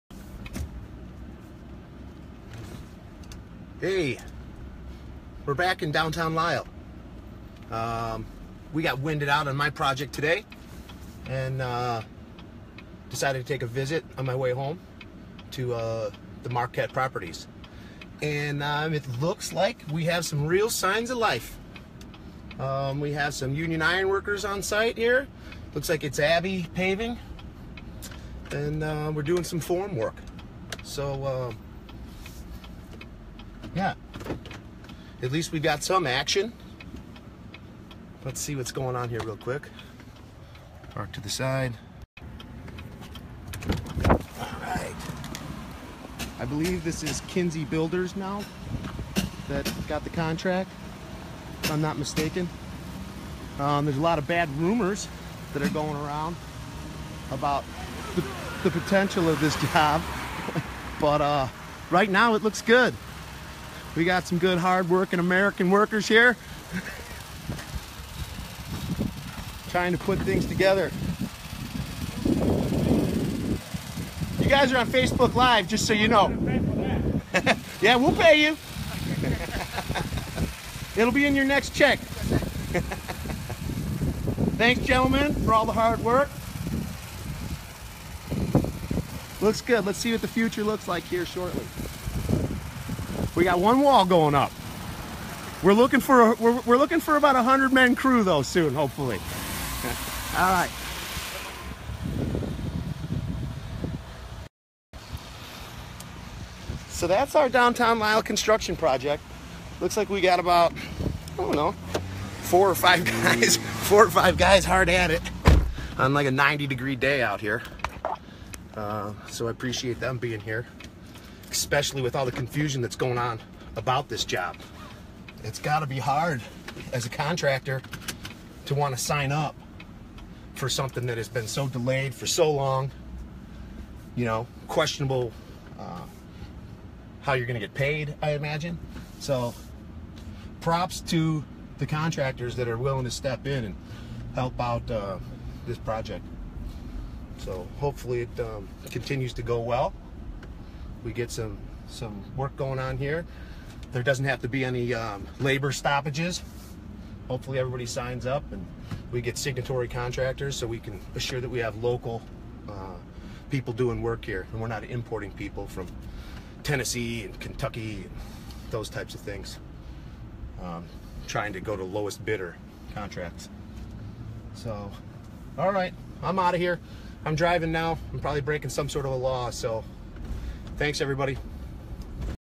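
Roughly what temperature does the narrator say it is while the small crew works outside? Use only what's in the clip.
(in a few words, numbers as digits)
90 degrees.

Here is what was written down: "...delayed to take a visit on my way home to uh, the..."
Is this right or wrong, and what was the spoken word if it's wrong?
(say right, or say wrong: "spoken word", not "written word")
wrong: "decided", not "delayed".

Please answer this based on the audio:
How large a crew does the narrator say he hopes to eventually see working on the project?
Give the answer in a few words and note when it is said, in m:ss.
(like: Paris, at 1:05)
100 men, at 1:37.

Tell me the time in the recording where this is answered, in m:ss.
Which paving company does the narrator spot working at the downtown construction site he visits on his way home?
0:26.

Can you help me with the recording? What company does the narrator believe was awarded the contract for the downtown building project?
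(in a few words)
Kinsey Builders.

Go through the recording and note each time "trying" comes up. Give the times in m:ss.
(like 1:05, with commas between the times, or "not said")
1:09, 2:51.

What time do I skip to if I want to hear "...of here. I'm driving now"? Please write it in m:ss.
2:56.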